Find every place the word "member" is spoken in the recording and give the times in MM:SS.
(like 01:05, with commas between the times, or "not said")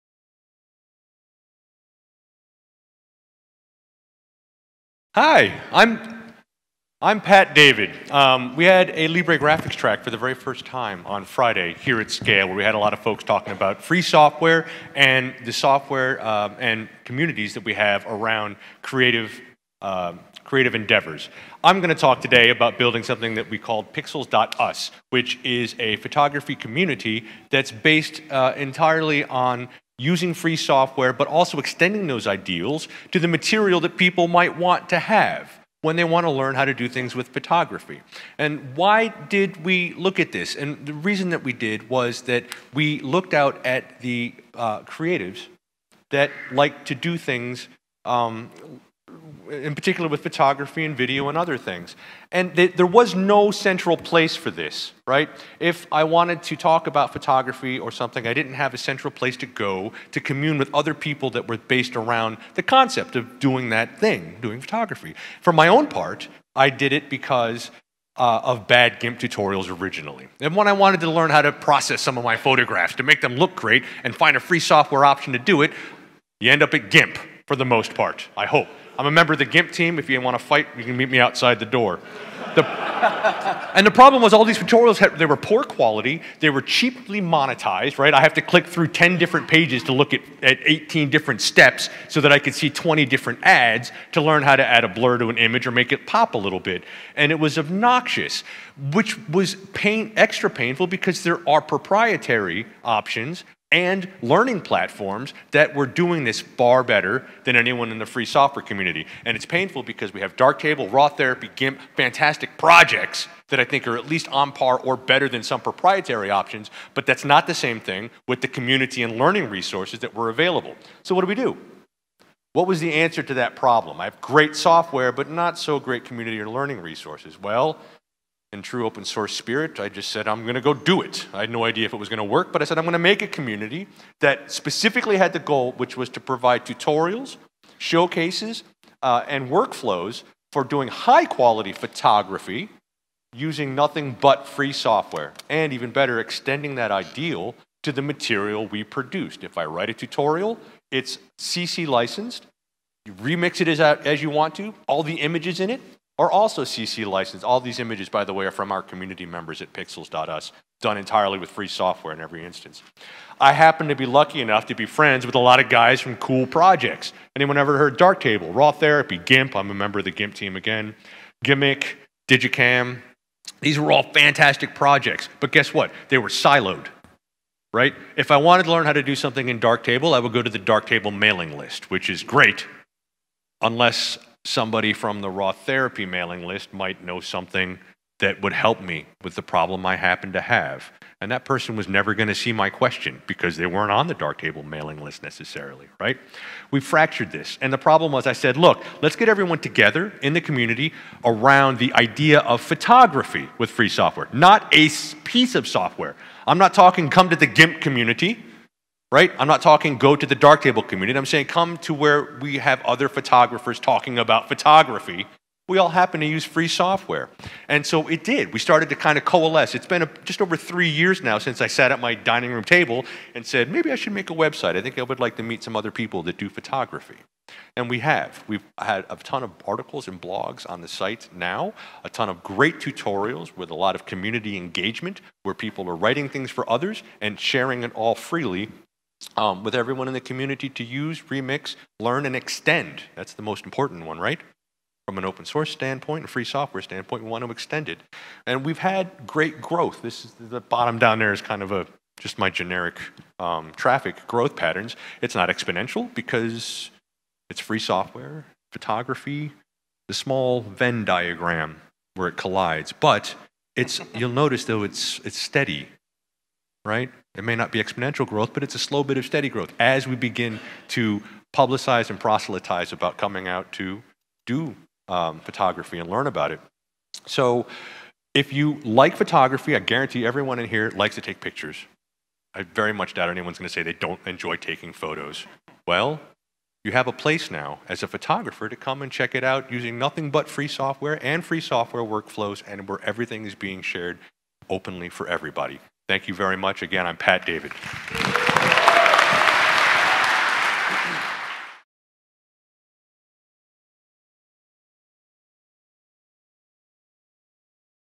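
01:19, 02:39, 02:49.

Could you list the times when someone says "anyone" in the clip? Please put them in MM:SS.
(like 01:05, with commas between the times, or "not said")
01:47, 02:47, 04:43.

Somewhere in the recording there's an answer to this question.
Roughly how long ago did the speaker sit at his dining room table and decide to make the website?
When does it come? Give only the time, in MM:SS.
03:40.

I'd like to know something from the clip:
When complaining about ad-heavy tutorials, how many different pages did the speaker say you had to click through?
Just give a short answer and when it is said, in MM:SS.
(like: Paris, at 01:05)
10, at 01:28.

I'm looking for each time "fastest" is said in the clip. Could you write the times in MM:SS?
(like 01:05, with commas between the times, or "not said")
not said.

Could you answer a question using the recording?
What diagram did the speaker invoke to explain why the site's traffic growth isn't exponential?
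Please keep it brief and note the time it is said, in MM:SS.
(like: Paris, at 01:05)
Venn diagram, at 04:20.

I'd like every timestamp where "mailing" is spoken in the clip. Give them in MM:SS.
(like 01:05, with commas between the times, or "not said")
03:01, 03:06, 03:14.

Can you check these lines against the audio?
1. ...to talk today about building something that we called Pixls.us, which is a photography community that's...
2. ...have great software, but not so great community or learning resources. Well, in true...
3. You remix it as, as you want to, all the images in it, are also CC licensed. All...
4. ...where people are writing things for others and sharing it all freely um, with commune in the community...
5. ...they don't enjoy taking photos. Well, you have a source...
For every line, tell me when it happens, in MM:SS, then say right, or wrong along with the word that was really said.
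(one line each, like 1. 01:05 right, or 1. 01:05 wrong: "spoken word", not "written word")
1. 00:21 right
2. 02:04 right
3. 02:33 right
4. 03:55 wrong: "everyone", not "commune"
5. 04:43 wrong: "place", not "source".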